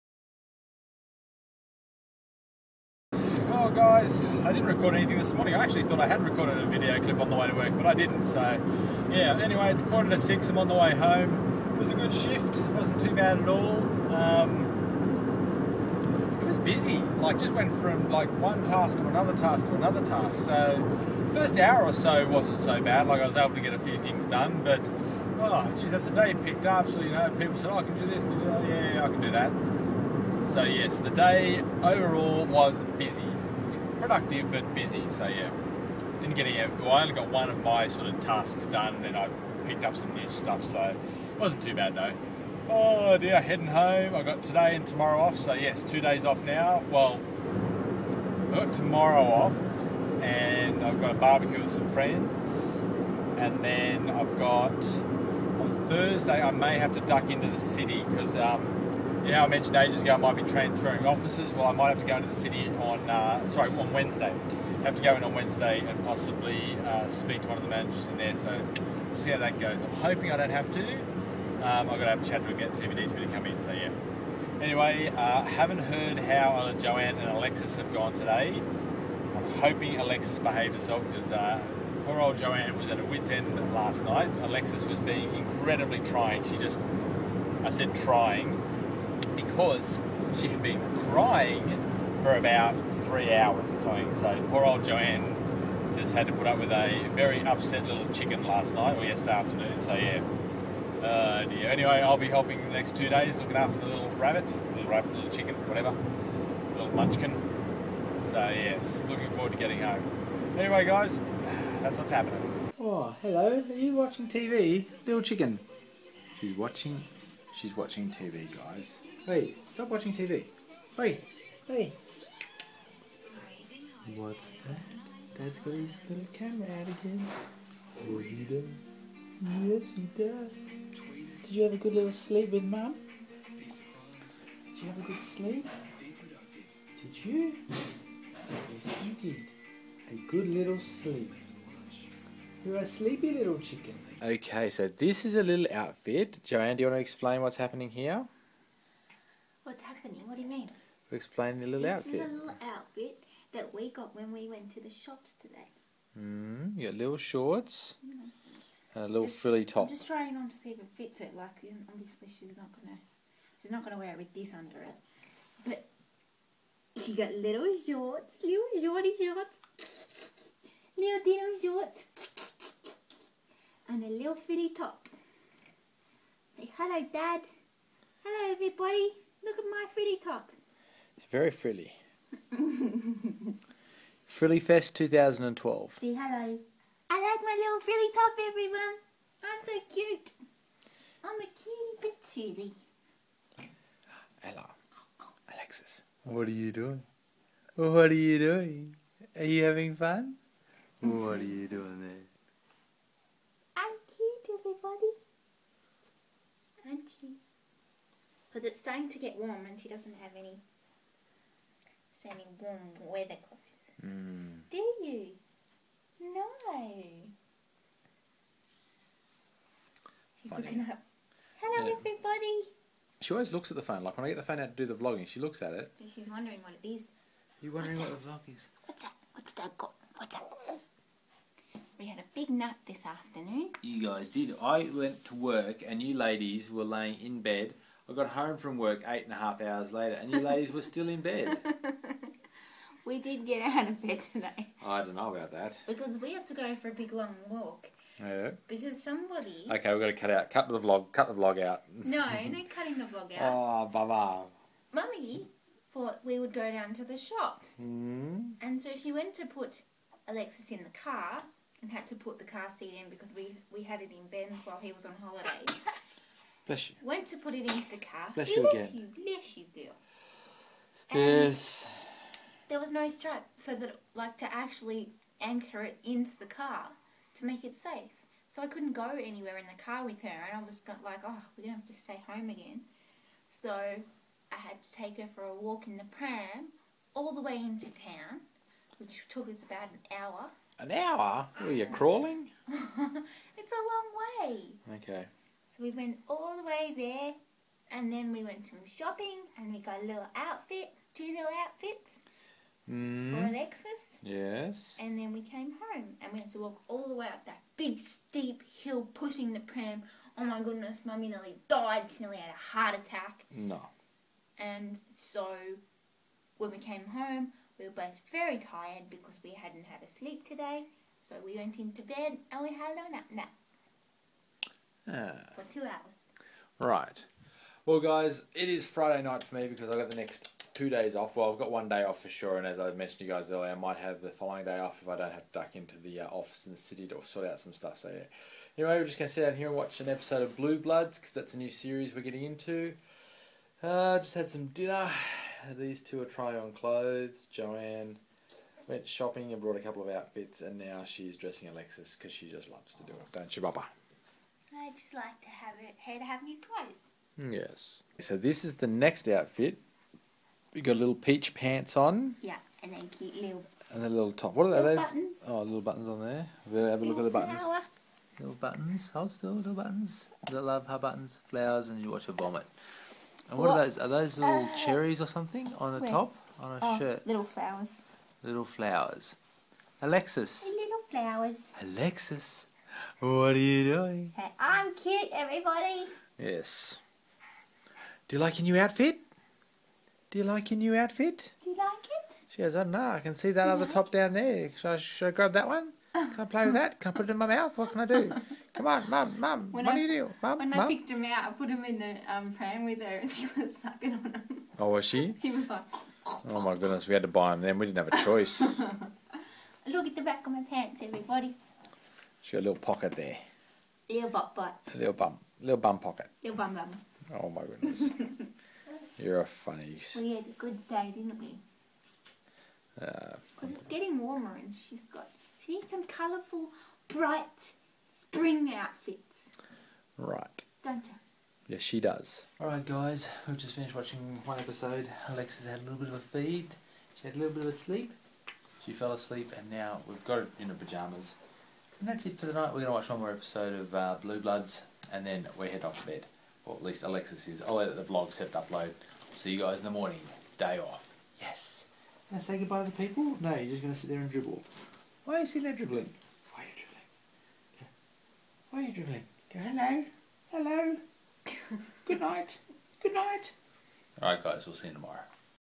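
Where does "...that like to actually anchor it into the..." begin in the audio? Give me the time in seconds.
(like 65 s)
273 s.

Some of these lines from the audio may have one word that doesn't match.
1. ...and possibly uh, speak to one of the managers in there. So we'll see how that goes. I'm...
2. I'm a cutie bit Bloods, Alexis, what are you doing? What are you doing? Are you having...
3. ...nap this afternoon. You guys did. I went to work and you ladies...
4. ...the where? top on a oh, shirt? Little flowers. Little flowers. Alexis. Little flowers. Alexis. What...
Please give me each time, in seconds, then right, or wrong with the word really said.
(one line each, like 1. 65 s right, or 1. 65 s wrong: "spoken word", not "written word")
1. 65 s right
2. 191 s wrong: "Ella", not "Bloods"
3. 232 s right
4. 375 s right.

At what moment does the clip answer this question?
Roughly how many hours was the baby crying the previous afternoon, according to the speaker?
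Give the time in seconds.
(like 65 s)
93 s.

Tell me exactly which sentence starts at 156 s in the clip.
Mm, you got little shorts mm.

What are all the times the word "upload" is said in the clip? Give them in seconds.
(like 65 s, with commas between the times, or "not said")
448 s.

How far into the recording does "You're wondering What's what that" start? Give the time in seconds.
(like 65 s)
227 s.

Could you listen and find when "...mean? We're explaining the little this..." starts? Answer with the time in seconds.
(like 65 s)
150 s.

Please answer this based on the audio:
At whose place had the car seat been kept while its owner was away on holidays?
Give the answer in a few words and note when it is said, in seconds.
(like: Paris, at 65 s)
Ben's, at 264 s.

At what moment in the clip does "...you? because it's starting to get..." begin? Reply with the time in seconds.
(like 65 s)
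207 s.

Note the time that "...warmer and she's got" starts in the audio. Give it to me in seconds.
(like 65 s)
424 s.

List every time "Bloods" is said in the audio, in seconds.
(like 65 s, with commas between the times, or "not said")
340 s, 444 s.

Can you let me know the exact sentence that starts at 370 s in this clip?
I love her buttons, flowers, and you watch her vomit.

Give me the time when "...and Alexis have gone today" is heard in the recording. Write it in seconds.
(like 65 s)
77 s.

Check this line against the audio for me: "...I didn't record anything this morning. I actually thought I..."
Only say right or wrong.
right.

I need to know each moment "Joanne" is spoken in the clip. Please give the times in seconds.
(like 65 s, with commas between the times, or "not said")
76 s, 82 s, 94 s, 146 s, 347 s.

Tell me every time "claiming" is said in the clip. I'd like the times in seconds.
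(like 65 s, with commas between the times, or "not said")
not said.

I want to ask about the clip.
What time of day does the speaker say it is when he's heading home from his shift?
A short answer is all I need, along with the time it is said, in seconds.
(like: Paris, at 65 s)
quarter to six, at 9 s.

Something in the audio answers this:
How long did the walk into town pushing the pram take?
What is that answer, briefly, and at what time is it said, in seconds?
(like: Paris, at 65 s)
about an hour, at 289 s.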